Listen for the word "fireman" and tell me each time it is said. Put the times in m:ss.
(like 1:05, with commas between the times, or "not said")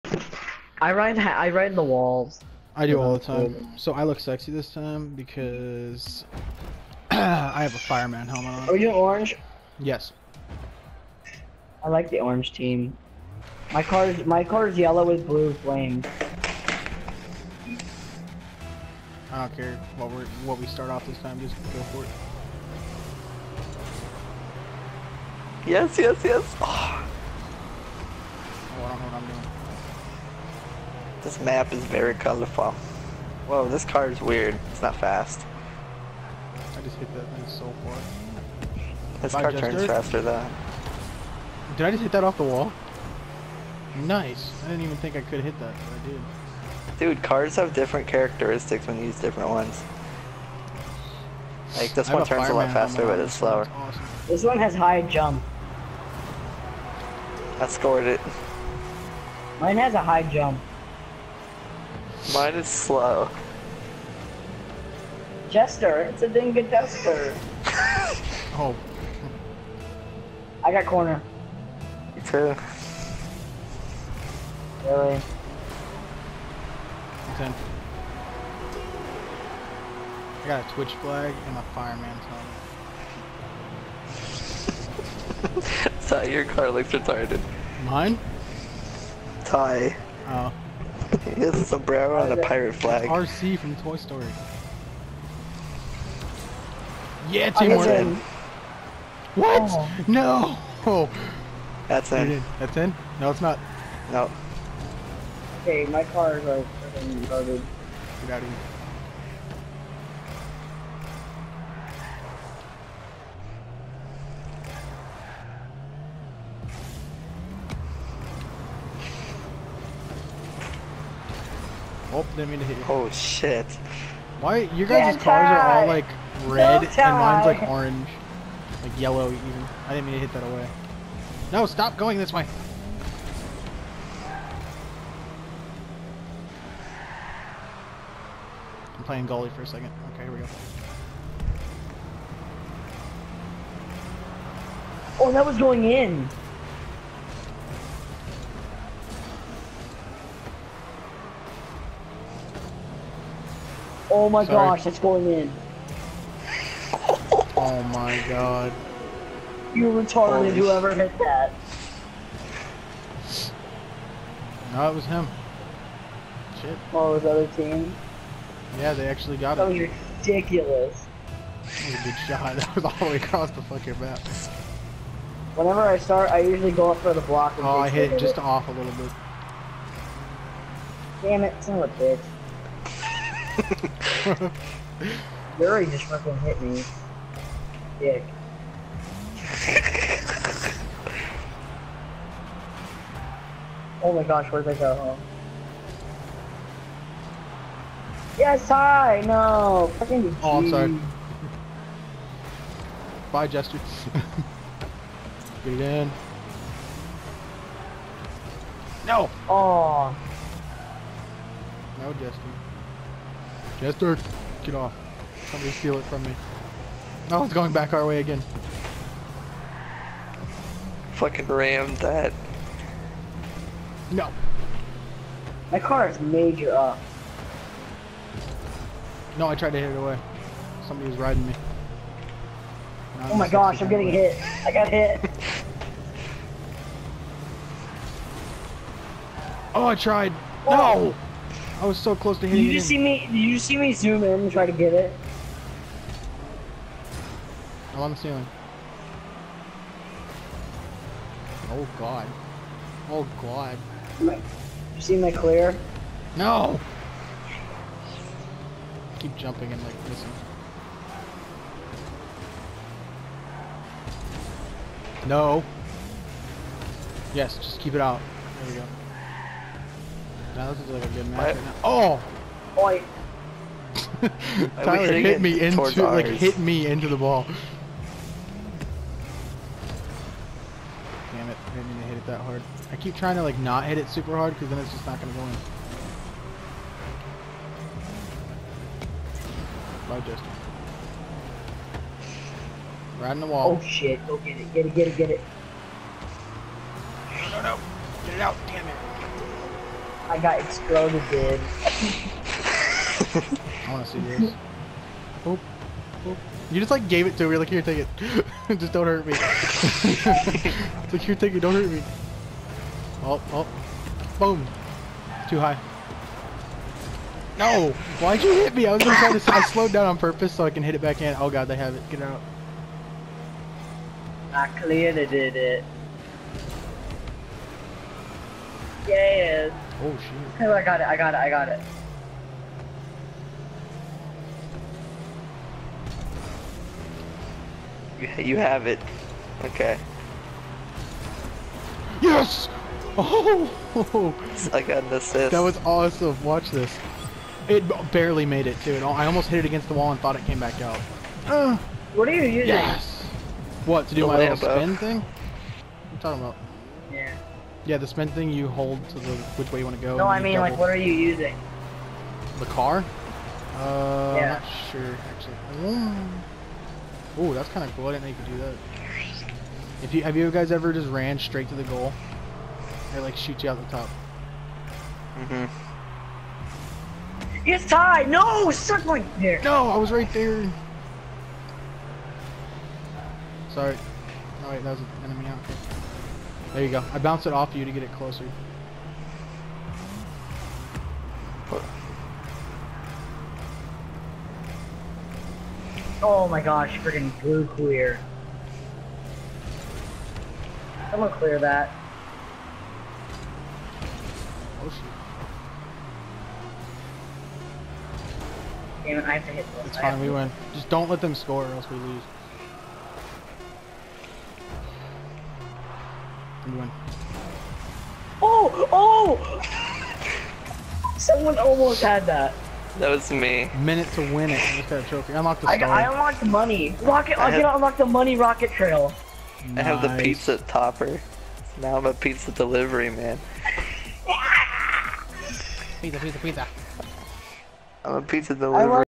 0:07, 1:21.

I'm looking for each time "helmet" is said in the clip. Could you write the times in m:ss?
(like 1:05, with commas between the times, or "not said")
0:08, 1:25.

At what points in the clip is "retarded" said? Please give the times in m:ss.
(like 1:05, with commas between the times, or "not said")
1:26, 2:39.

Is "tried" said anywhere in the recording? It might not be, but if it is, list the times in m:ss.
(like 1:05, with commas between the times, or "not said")
3:49, 3:59.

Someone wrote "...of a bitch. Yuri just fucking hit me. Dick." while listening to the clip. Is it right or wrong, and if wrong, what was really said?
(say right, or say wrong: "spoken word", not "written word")
right.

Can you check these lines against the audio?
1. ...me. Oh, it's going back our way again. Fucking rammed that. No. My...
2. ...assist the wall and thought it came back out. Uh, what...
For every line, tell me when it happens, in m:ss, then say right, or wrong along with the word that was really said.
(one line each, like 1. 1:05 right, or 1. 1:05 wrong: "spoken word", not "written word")
1. 3:36 right
2. 5:49 wrong: "against", not "assist".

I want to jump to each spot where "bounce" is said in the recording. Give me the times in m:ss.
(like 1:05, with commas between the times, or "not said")
6:27.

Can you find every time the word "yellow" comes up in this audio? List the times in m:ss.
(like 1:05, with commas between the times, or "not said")
0:14, 2:08.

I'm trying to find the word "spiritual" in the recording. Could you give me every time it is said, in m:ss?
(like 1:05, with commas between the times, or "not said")
not said.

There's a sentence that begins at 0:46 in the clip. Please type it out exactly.
Dude, cars have different characteristics when you use different ones.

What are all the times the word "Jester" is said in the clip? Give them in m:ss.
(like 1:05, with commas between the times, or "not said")
1:05, 3:23, 3:32.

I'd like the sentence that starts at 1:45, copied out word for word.
Okay, my car is like garbage.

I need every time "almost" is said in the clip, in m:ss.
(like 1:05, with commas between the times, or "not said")
5:49, 7:01.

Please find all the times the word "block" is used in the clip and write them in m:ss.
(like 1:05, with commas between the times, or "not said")
2:57.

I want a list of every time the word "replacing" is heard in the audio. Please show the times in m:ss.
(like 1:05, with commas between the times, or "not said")
not said.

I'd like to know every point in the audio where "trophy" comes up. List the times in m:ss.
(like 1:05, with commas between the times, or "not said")
7:05.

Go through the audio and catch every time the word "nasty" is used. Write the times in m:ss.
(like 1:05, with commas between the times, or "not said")
not said.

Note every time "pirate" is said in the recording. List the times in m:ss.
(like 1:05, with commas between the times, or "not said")
1:32.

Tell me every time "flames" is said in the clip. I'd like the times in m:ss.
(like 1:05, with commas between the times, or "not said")
0:15.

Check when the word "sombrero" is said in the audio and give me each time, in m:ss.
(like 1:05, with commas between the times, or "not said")
1:31.